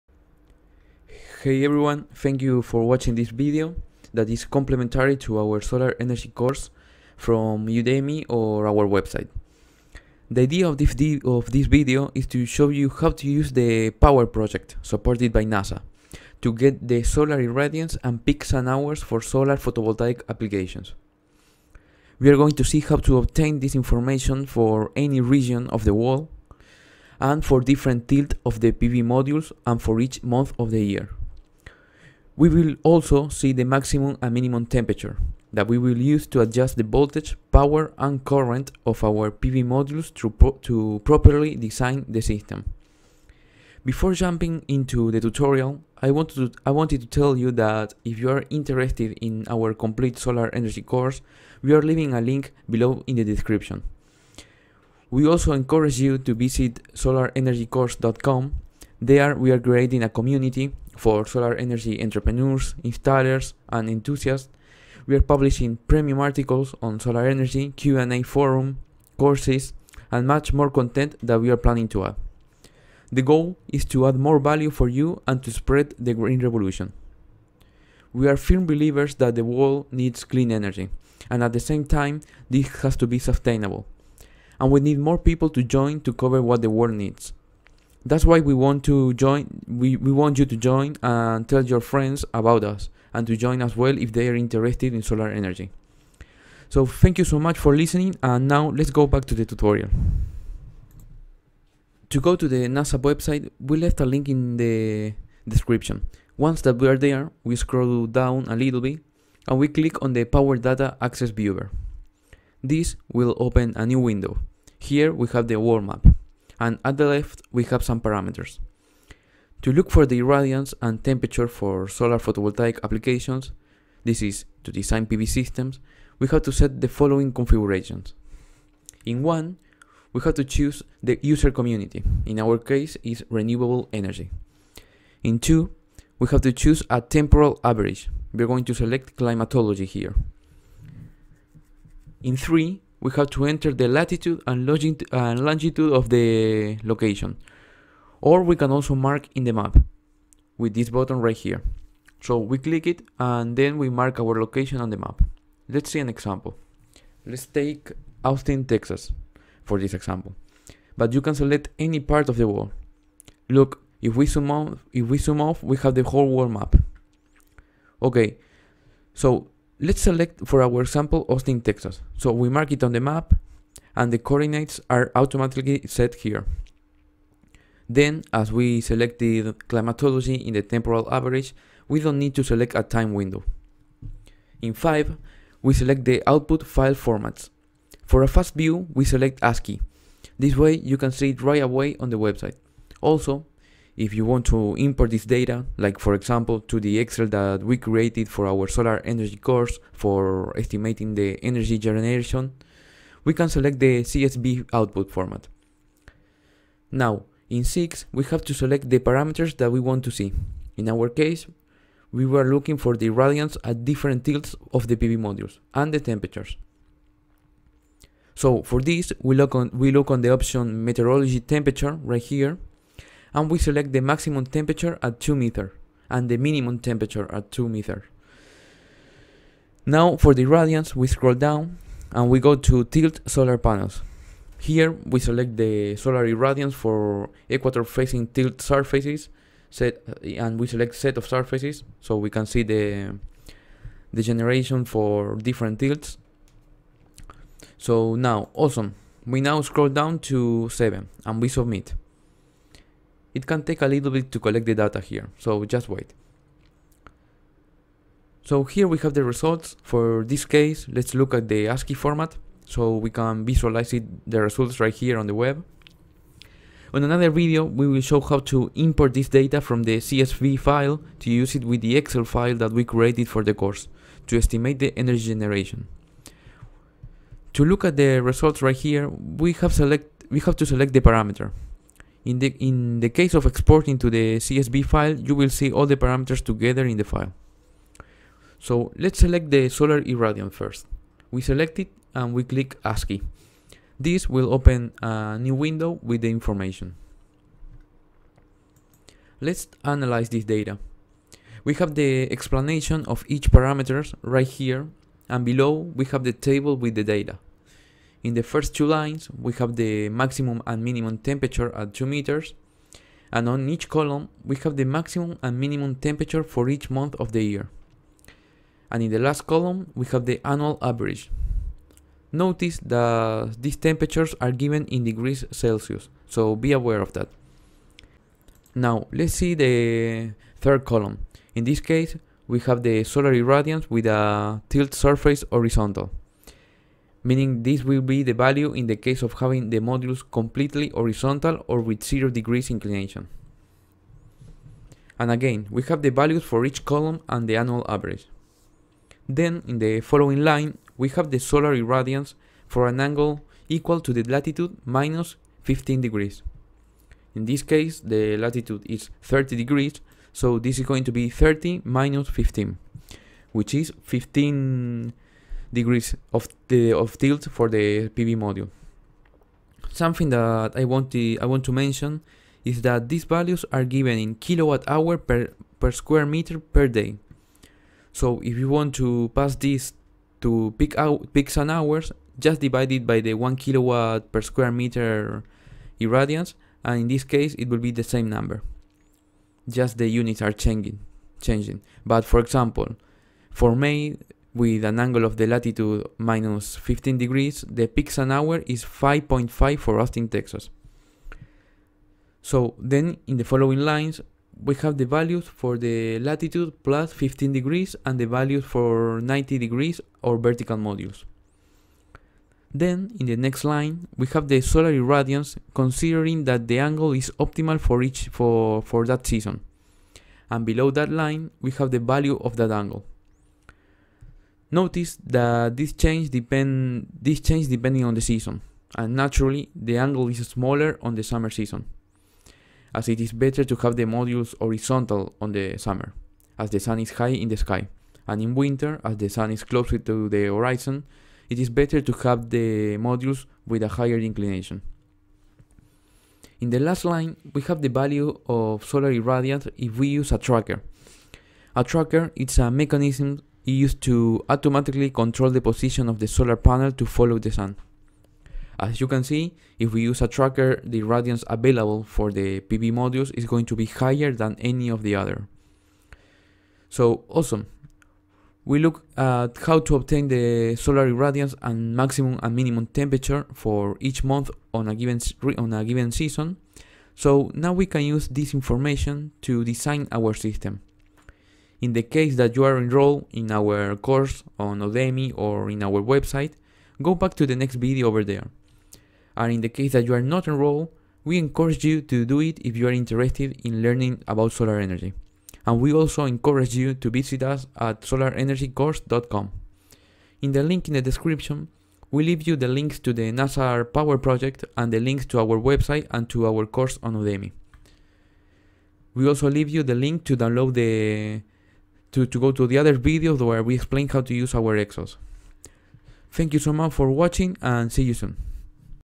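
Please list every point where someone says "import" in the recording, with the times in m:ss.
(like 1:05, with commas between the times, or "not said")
3:14, 4:28.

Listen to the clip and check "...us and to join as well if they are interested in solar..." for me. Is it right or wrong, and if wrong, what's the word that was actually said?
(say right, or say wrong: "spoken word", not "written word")
right.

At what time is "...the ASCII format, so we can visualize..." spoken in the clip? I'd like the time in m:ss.
4:21.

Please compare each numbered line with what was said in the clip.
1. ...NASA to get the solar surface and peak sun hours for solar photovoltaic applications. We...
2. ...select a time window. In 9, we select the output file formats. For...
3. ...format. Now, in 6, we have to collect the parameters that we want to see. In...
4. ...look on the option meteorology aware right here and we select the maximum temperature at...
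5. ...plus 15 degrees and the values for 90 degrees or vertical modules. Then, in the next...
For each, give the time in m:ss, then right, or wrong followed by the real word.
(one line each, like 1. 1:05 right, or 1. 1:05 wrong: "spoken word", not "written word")
1. 0:15 wrong: "irradiance", not "surface"
2. 3:02 wrong: "5", not "9"
3. 3:25 wrong: "select", not "collect"
4. 3:39 wrong: "temperature", not "aware"
5. 6:46 right.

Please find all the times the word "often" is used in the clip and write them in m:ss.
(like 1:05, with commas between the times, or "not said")
not said.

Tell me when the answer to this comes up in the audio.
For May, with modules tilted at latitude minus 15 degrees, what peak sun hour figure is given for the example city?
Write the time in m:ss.
6:38.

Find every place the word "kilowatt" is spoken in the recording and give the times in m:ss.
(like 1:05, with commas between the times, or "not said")
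6:14, 6:23.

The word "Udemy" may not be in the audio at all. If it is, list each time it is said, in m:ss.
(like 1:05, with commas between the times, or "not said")
0:07, 8:04, 8:27.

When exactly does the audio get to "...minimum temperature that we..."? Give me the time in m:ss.
0:34.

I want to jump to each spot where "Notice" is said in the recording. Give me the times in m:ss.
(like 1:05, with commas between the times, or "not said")
5:22, 7:04.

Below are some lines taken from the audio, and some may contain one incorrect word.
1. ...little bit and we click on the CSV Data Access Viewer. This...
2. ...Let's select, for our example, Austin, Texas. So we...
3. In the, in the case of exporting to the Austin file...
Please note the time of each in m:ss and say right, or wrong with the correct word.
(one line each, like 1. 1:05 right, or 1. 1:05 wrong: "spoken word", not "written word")
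1. 1:48 wrong: "Power", not "CSV"
2. 2:49 right
3. 4:42 wrong: "CSV", not "Austin".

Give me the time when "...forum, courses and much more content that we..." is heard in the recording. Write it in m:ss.
1:08.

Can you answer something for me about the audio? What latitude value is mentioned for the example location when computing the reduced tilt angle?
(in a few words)
30 degrees.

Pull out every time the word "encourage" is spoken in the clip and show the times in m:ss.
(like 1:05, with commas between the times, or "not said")
0:55, 8:11, 8:16.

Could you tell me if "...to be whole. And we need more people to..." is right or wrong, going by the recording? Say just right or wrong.
wrong.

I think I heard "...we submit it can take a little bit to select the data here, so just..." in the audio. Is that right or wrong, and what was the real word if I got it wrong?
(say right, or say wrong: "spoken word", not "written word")
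wrong: "collect", not "select".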